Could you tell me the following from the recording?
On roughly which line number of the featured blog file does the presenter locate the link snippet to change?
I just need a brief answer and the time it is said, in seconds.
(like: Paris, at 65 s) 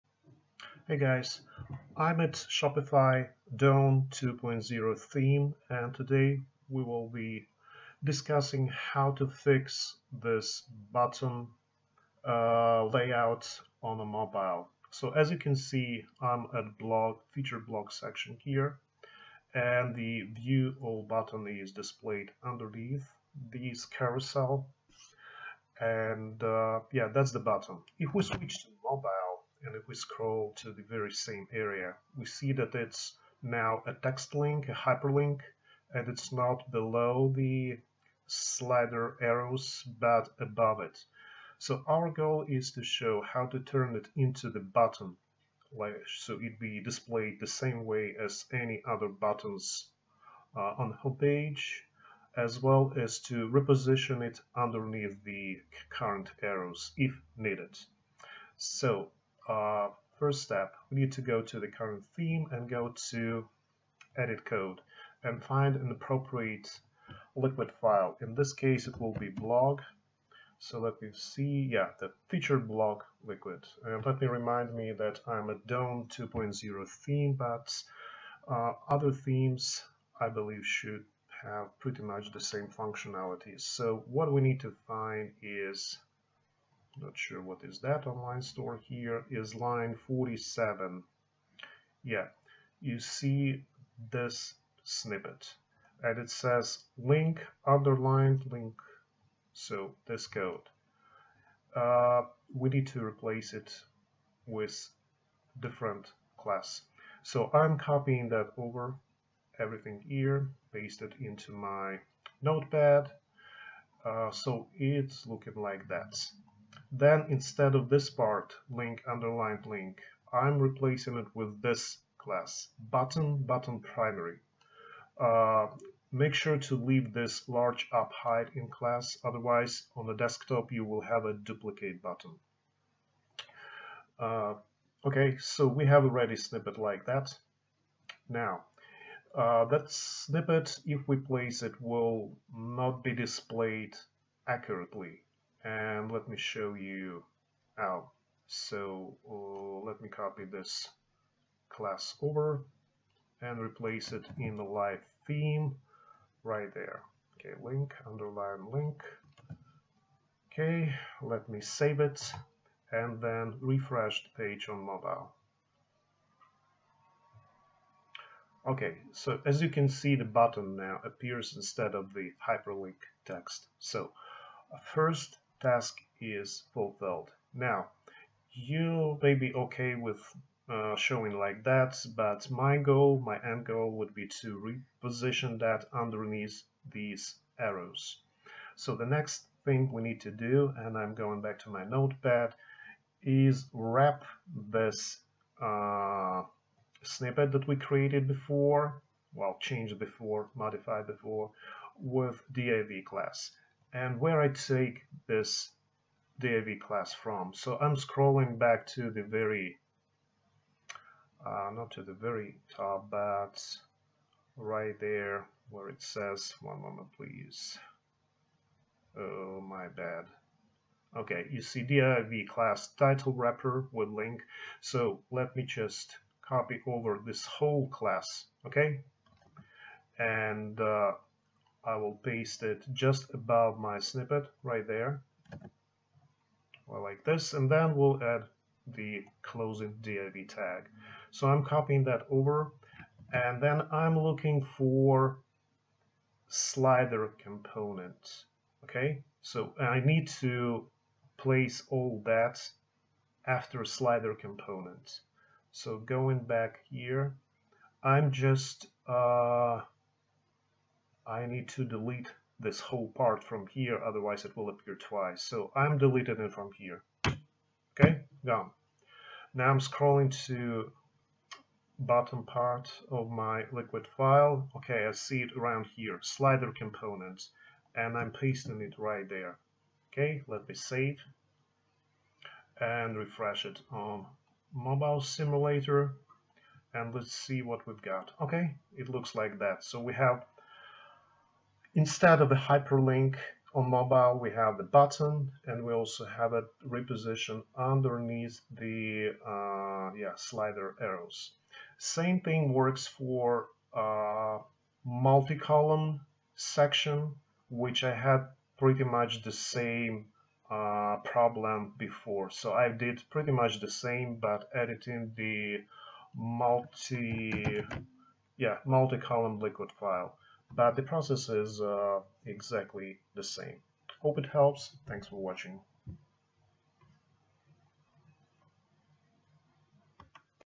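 47, at 90 s.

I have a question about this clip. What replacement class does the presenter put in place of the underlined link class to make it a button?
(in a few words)
button button primary.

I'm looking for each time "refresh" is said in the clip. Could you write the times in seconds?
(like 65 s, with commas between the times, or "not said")
163 s, 283 s.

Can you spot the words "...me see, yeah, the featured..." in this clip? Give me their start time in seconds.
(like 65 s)
71 s.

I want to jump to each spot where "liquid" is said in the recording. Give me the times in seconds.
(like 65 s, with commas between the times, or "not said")
67 s, 73 s, 273 s, 319 s.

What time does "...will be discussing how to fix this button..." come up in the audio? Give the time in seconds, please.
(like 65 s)
6 s.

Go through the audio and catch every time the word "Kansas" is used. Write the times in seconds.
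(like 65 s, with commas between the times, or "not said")
not said.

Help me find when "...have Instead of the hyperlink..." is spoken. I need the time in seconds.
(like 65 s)
290 s.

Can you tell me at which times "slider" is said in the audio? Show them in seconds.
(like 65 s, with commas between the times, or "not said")
38 s, 246 s, 253 s, 276 s, 300 s.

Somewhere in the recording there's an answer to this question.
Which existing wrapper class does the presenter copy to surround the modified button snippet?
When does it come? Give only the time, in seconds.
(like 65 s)
222 s.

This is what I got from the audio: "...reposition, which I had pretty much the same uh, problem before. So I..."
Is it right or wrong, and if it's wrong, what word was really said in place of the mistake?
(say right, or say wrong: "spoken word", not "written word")
wrong: "section", not "reposition".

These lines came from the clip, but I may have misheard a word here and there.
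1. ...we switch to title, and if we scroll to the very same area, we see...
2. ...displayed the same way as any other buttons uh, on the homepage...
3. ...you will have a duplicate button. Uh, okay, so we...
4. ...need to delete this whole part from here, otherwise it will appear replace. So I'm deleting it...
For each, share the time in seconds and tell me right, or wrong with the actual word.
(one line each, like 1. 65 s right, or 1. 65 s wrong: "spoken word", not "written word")
1. 28 s wrong: "mobile", not "title"
2. 46 s right
3. 130 s right
4. 261 s wrong: "twice", not "replace".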